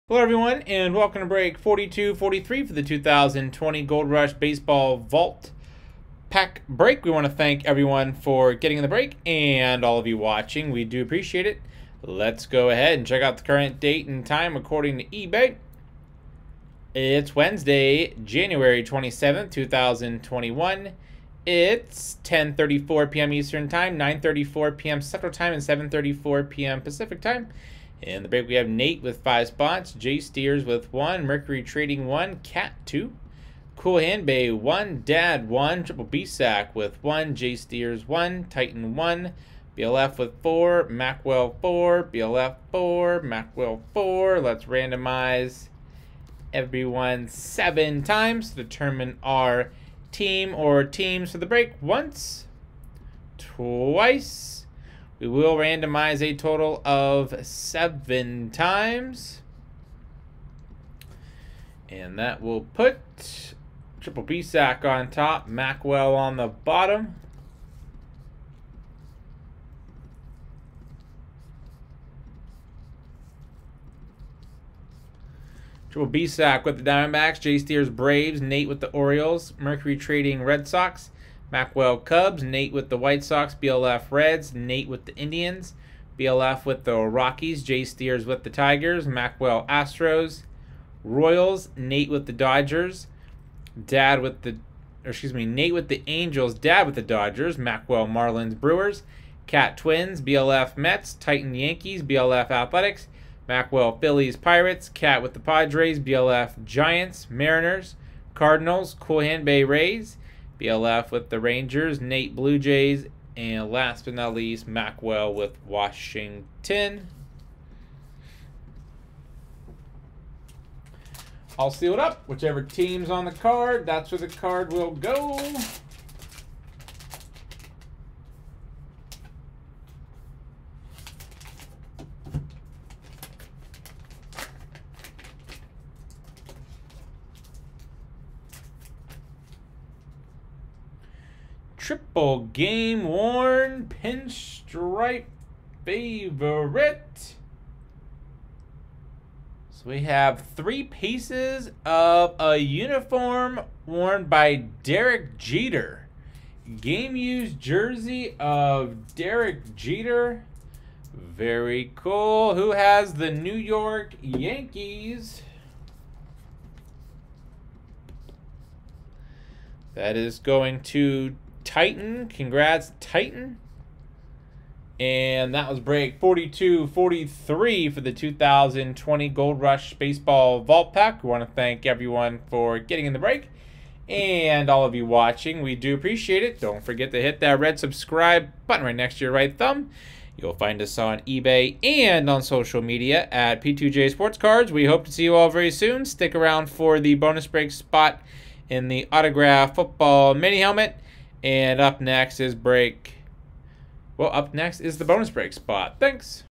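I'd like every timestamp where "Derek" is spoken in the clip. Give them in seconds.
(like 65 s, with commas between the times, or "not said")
154 s, 159 s.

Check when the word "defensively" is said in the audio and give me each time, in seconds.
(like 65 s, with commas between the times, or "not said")
not said.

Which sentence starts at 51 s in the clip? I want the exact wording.
Once, twice, we will randomize a total of seven times.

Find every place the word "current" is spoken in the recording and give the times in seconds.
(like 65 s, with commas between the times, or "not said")
13 s.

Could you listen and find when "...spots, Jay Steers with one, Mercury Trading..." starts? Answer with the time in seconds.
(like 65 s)
29 s.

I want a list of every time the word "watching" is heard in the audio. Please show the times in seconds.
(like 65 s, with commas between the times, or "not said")
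10 s, 185 s.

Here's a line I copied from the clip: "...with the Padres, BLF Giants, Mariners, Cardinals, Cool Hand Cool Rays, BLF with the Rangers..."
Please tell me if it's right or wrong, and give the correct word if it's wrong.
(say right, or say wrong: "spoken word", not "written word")
wrong: "Bay", not "Cool".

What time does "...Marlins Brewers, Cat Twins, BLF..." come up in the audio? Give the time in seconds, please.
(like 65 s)
98 s.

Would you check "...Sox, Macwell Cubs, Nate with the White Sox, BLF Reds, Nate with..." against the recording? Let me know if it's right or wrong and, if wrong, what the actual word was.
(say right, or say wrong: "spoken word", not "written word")
right.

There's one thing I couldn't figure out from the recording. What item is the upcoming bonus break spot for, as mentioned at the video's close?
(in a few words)
autograph football mini helmet.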